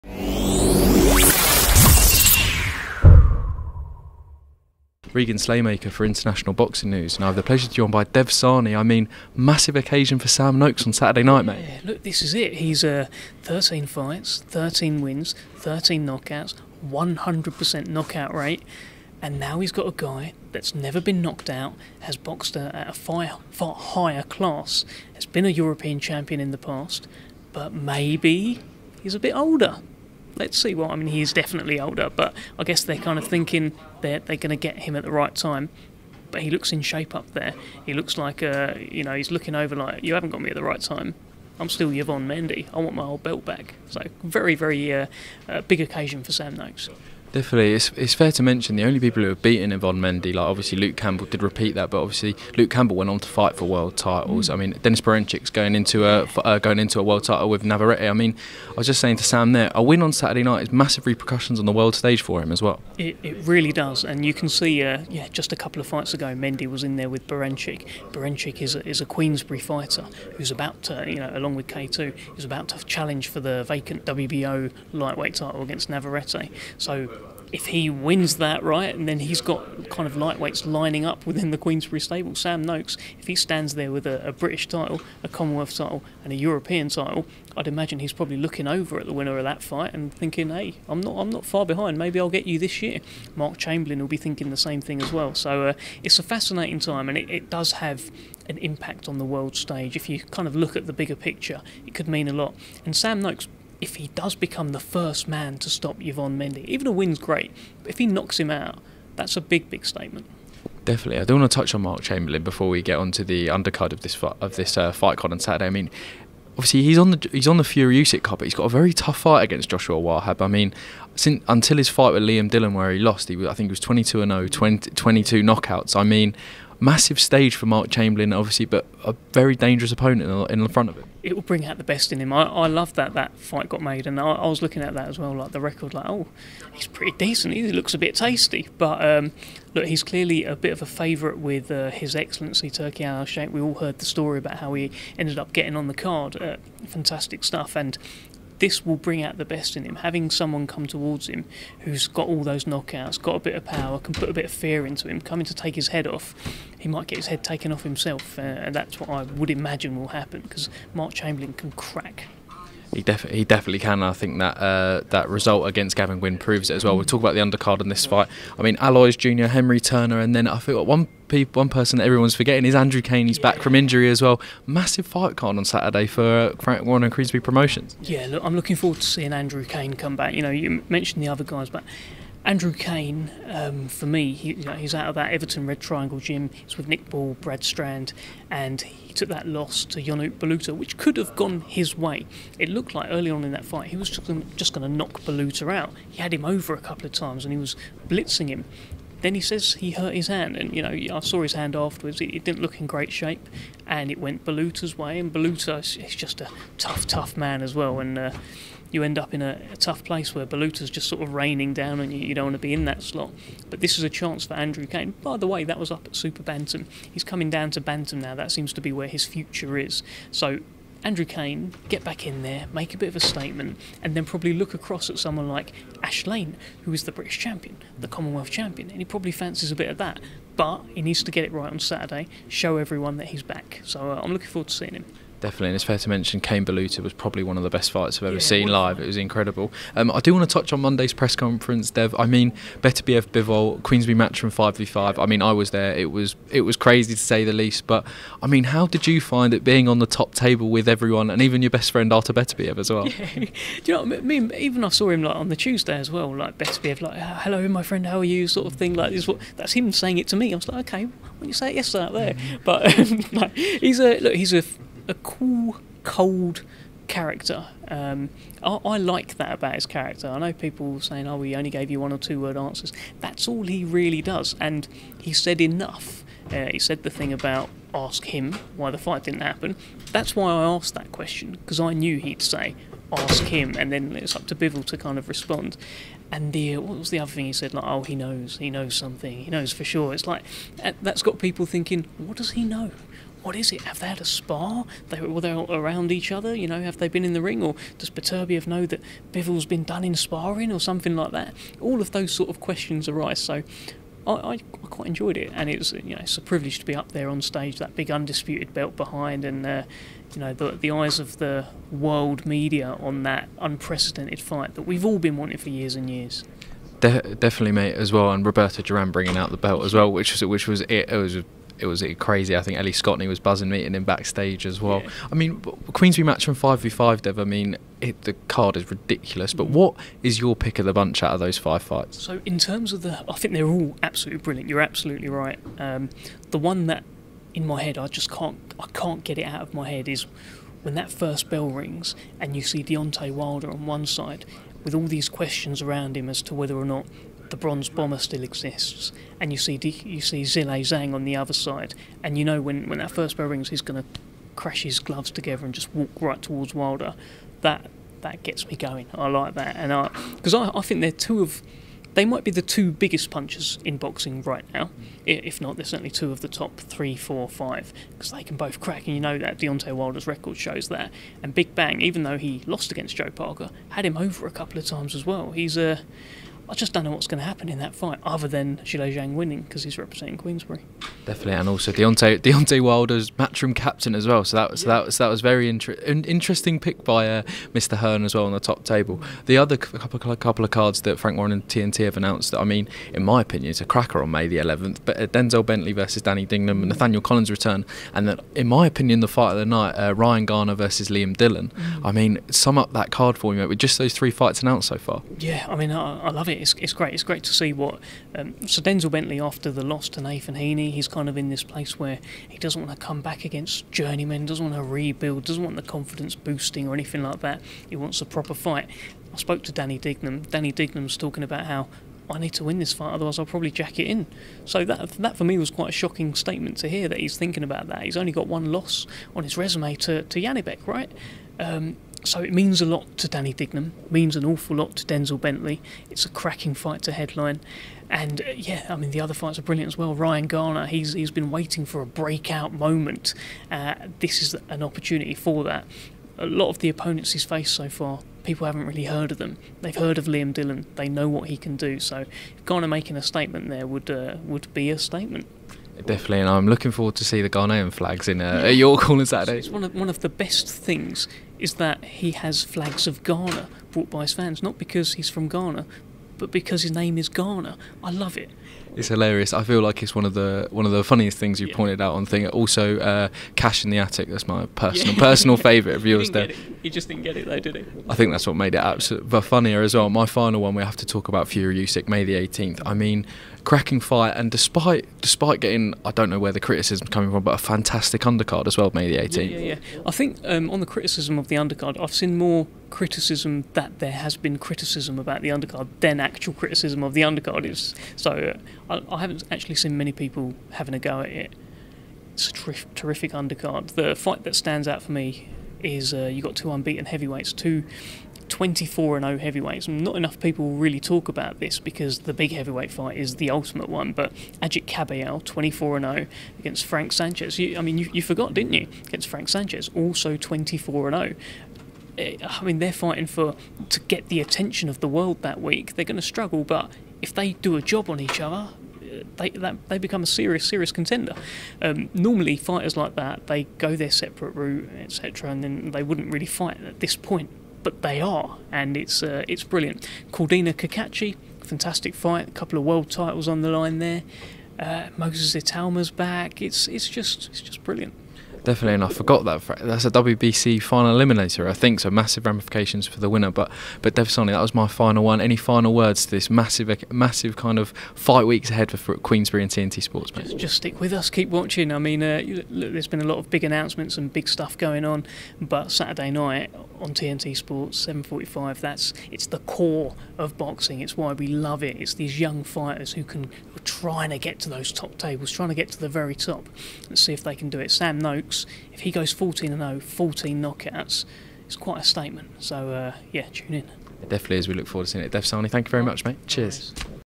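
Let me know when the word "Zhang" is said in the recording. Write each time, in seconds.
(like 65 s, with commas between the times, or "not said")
350 s, 379 s.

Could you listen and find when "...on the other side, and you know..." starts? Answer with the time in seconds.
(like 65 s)
351 s.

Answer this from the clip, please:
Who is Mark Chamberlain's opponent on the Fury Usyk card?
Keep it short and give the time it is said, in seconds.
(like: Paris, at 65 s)
Joshua Wahab, at 119 s.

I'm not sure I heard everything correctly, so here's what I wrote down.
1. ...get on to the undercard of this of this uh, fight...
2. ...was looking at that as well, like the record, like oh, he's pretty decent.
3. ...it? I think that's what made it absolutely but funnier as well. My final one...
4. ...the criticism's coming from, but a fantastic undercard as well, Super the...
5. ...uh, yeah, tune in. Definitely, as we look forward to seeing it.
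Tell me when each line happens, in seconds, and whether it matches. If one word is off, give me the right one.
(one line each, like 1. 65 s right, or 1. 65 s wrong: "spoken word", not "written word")
1. 112 s right
2. 134 s right
3. 477 s right
4. 486 s wrong: "May", not "Super"
5. 582 s right.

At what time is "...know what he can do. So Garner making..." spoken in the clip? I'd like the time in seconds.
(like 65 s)
451 s.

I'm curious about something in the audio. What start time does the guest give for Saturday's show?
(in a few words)
7:45.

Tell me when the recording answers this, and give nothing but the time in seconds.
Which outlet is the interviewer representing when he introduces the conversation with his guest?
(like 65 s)
6 s.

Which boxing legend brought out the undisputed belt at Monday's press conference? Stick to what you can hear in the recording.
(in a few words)
Roberto Duran.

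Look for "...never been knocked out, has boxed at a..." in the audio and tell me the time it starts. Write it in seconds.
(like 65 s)
20 s.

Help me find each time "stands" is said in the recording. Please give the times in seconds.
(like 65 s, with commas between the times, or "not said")
83 s, 504 s.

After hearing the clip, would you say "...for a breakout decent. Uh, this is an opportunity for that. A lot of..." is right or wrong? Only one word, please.
wrong.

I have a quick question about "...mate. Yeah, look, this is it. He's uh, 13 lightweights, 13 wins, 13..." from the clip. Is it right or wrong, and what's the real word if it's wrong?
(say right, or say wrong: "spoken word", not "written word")
wrong: "fights", not "lightweights".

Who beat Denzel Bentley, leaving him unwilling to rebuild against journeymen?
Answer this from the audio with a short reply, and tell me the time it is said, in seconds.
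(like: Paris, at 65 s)
Nathan Heaney, at 410 s.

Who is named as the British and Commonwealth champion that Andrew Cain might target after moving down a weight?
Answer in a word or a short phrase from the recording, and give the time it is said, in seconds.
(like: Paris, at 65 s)
Ash Lane, at 226 s.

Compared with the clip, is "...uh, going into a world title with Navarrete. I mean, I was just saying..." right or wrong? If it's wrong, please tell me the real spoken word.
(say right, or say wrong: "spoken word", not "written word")
right.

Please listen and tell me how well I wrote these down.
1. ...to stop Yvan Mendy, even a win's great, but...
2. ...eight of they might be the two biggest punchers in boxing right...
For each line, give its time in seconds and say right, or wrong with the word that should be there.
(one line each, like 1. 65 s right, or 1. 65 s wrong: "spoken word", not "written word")
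1. 105 s right
2. 361 s wrong: "two", not "eight".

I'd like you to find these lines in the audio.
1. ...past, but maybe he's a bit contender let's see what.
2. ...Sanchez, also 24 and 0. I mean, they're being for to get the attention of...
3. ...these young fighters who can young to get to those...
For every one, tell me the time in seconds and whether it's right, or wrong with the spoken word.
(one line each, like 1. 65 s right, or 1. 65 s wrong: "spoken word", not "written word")
1. 26 s wrong: "older", not "contender"
2. 519 s wrong: "fighting", not "being"
3. 572 s wrong: "trying", not "young".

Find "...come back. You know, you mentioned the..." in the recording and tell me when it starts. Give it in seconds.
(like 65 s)
179 s.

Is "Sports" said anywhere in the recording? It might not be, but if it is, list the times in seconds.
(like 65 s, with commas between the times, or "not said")
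560 s, 567 s.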